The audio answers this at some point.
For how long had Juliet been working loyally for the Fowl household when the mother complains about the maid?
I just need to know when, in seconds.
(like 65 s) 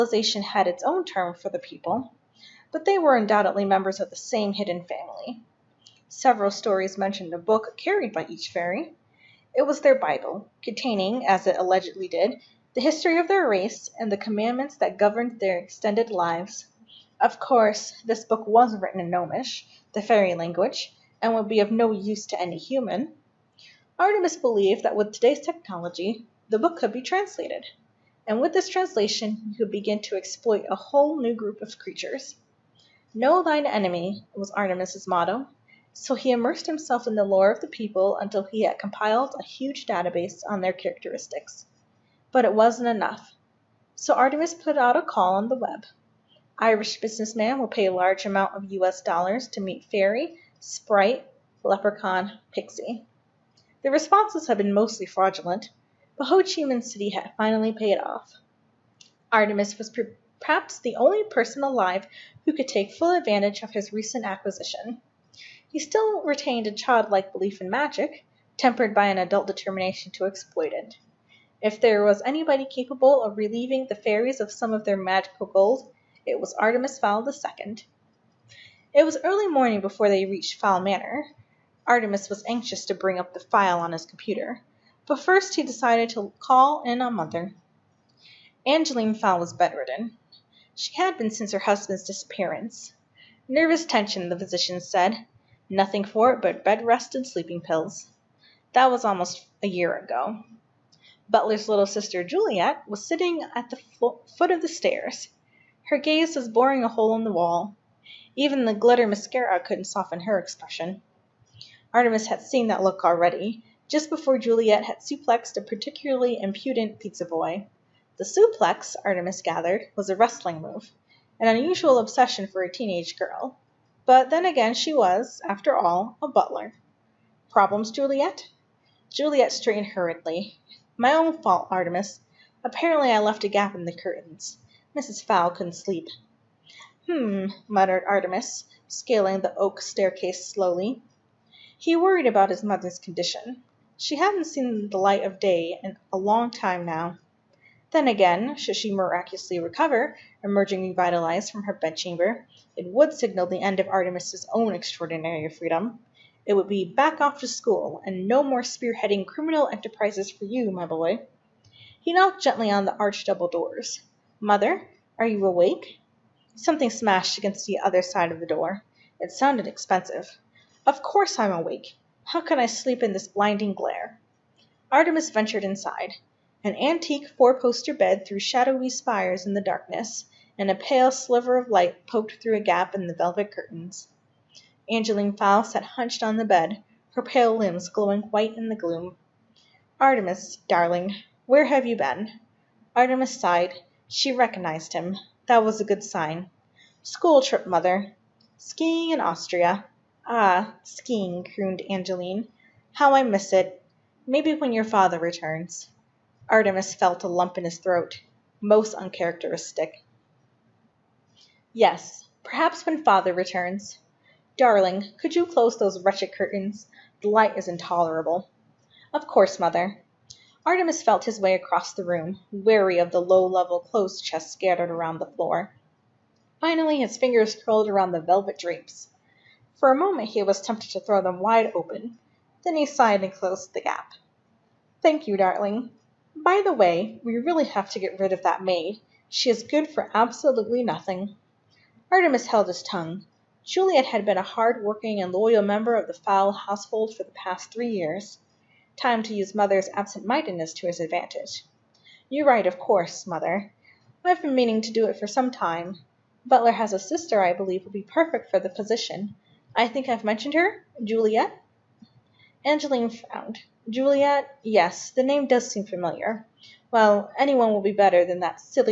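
247 s.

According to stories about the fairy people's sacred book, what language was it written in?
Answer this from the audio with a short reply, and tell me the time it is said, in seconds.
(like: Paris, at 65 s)
Gnomish, at 19 s.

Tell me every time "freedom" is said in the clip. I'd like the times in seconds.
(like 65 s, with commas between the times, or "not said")
155 s.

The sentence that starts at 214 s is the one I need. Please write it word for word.
Darling, could you close those wretched curtains?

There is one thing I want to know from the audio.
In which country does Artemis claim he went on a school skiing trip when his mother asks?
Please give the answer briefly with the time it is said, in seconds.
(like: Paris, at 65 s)
Austria, at 199 s.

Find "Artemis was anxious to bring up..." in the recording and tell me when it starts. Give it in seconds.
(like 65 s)
81 s.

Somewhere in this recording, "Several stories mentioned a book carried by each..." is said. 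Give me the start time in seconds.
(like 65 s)
6 s.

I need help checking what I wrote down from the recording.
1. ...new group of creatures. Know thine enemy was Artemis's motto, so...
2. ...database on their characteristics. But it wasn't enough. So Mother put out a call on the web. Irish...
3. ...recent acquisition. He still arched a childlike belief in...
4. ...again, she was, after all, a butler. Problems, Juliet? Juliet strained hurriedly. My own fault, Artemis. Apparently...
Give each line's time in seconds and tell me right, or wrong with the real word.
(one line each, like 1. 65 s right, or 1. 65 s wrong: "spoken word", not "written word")
1. 31 s right
2. 39 s wrong: "Artemis", not "Mother"
3. 63 s wrong: "retained", not "arched"
4. 124 s right.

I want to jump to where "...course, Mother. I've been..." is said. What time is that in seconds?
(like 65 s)
252 s.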